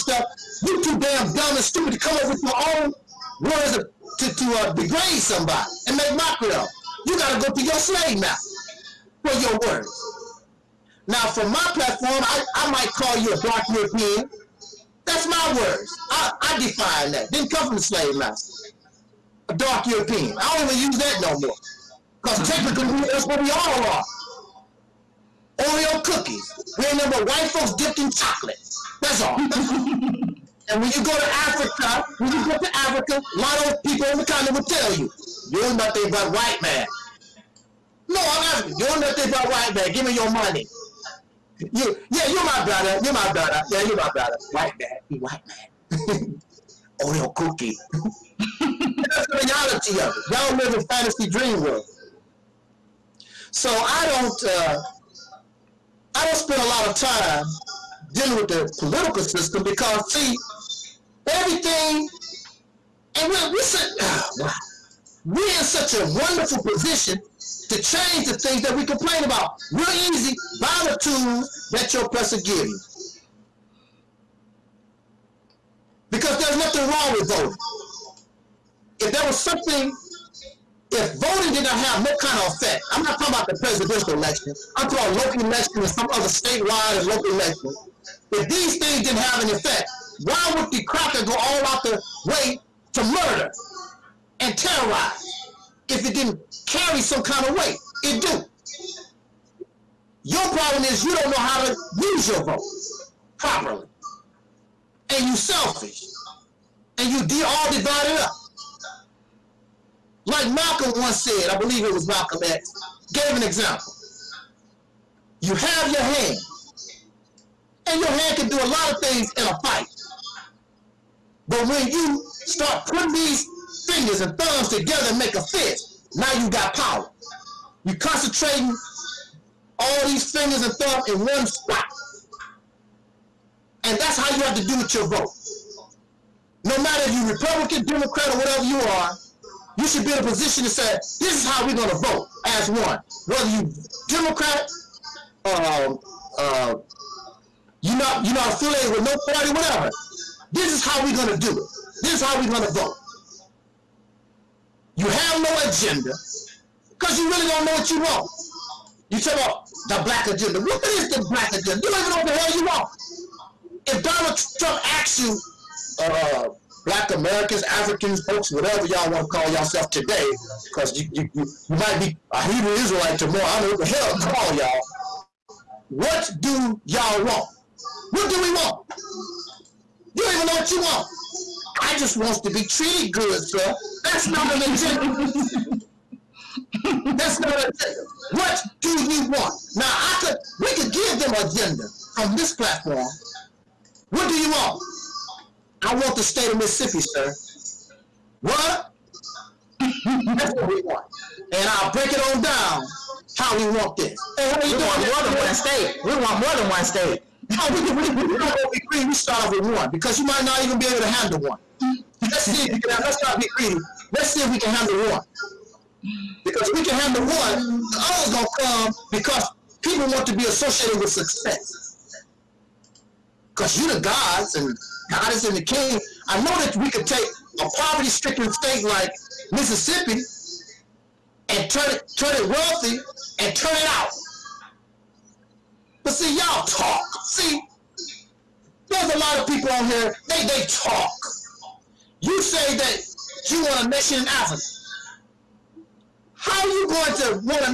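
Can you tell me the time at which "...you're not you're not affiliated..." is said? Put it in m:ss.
2:27.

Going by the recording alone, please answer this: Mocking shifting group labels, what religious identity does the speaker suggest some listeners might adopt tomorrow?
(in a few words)
Hebrew Israelite.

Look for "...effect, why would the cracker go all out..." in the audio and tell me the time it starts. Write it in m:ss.
1:29.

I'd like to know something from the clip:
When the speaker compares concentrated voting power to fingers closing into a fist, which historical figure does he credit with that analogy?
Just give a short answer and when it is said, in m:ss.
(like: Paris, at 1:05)
Malcolm X, at 1:52.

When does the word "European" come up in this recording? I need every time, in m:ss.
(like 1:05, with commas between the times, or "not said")
0:13, 0:19.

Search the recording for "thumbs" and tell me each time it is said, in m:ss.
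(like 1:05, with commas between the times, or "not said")
2:04, 2:10.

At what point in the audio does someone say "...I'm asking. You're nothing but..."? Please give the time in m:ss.
0:38.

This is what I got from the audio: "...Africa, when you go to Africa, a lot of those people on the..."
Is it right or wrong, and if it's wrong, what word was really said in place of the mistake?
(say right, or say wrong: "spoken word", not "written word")
right.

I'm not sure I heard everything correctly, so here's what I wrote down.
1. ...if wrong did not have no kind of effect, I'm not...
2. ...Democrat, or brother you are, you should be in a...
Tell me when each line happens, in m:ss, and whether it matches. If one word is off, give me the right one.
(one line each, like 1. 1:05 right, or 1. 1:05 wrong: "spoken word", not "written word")
1. 1:20 wrong: "voting", not "wrong"
2. 2:17 wrong: "whatever", not "brother".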